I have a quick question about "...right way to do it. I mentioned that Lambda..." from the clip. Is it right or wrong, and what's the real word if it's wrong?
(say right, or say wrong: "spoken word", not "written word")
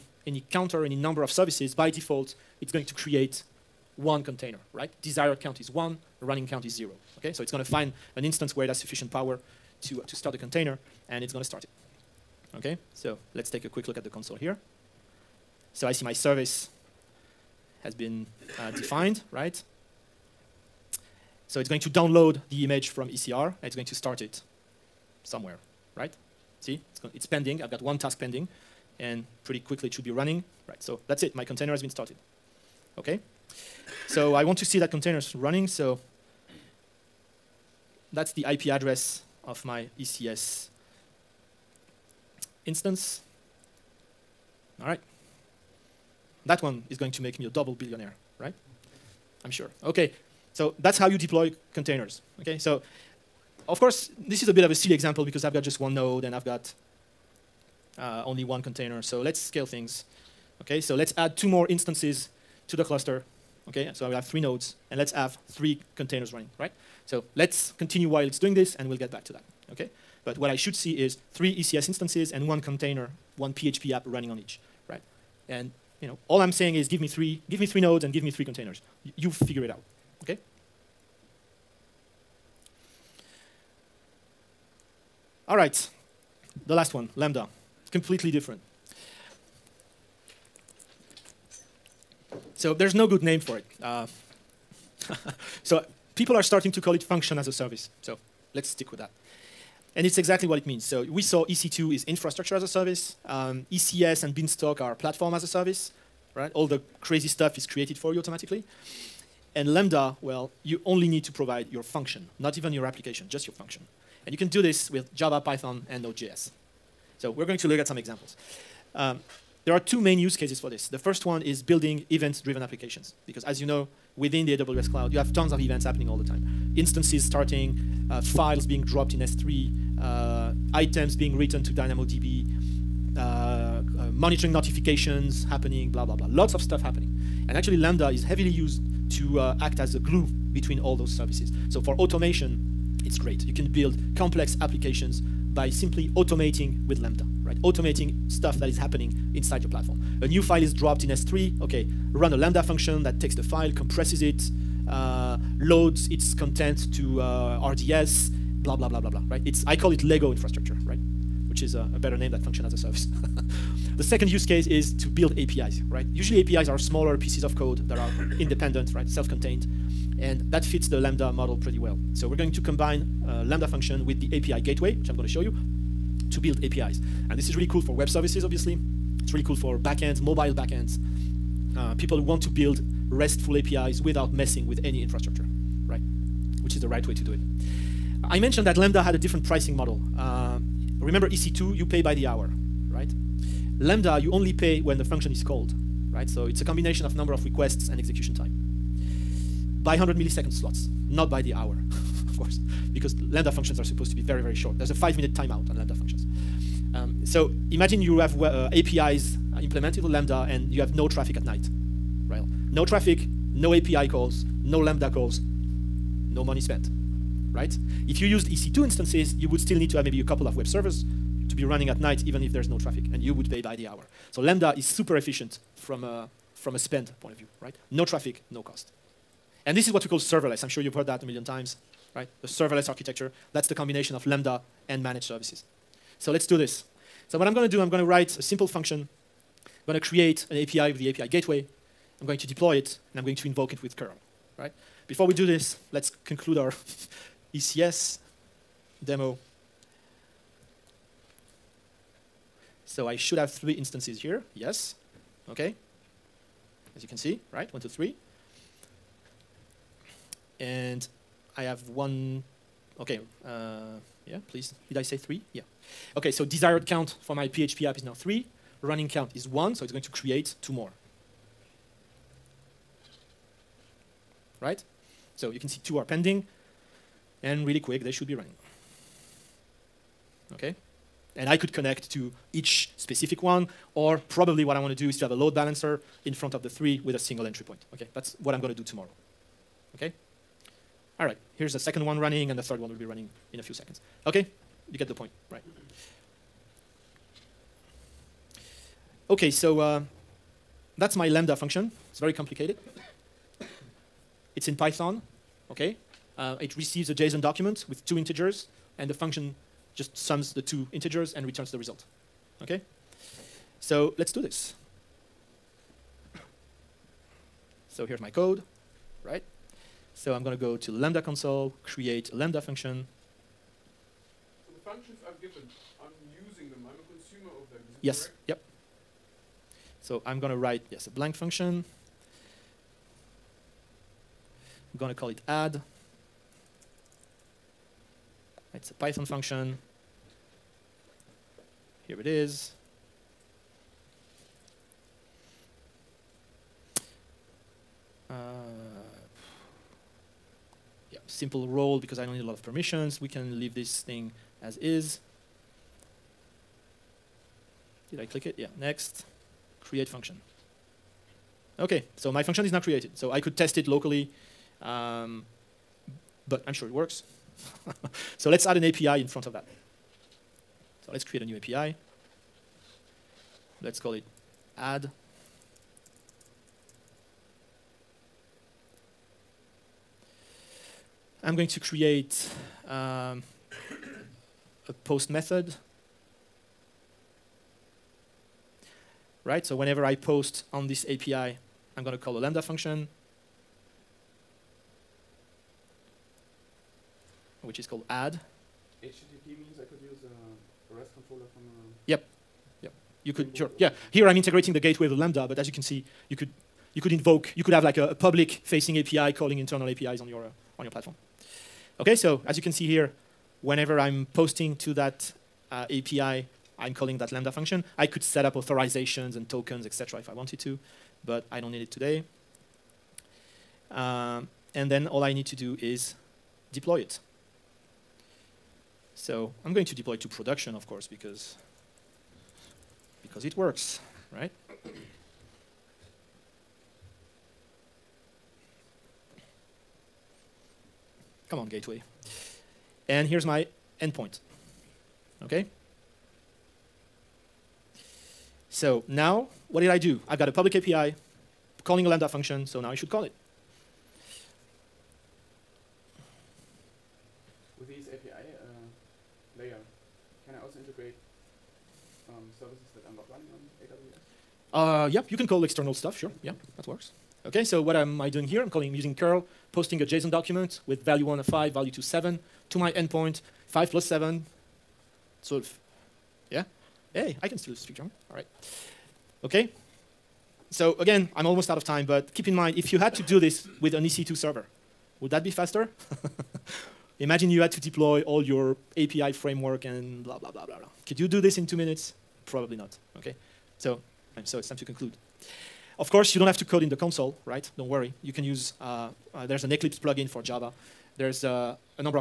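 right.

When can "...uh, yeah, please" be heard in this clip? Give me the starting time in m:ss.
4:23.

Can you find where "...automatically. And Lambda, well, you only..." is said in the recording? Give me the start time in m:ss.
1:48.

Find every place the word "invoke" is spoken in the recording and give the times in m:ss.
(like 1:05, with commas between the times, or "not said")
4:03, 6:47.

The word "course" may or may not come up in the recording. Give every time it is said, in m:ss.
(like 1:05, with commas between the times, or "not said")
0:53, 3:22, 7:10, 8:16.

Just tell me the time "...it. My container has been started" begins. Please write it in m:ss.
0:31.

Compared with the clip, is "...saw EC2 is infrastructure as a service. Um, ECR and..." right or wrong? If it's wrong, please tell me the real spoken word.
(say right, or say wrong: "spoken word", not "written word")
wrong: "ECS", not "ECR".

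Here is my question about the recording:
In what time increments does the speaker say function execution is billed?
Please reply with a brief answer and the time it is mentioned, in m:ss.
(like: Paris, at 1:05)
100 milliseconds, at 3:19.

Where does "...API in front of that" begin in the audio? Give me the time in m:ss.
6:08.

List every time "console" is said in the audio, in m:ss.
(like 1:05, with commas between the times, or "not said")
0:14, 5:21, 8:16.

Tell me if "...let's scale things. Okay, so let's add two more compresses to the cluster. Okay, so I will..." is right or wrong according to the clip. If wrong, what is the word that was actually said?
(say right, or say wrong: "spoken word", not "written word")
wrong: "instances", not "compresses".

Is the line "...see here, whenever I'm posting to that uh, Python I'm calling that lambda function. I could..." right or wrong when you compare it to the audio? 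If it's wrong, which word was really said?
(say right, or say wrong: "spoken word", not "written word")
wrong: "API", not "Python".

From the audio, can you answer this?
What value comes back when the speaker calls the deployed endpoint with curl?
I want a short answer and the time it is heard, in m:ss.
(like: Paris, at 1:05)
12, at 7:55.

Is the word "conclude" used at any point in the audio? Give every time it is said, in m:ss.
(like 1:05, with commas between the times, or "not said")
4:06, 8:14.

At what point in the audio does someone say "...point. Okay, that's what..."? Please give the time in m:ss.
4:47.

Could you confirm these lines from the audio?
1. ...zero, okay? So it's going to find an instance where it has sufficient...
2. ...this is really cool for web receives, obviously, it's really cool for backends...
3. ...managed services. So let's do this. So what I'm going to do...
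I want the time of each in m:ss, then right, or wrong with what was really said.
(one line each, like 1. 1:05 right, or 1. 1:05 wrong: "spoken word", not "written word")
1. 0:06 right
2. 2:57 wrong: "services", not "receives"
3. 3:55 right.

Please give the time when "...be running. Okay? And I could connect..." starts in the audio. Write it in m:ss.
4:38.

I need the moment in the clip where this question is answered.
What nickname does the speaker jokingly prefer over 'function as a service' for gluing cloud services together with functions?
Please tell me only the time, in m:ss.
2:40.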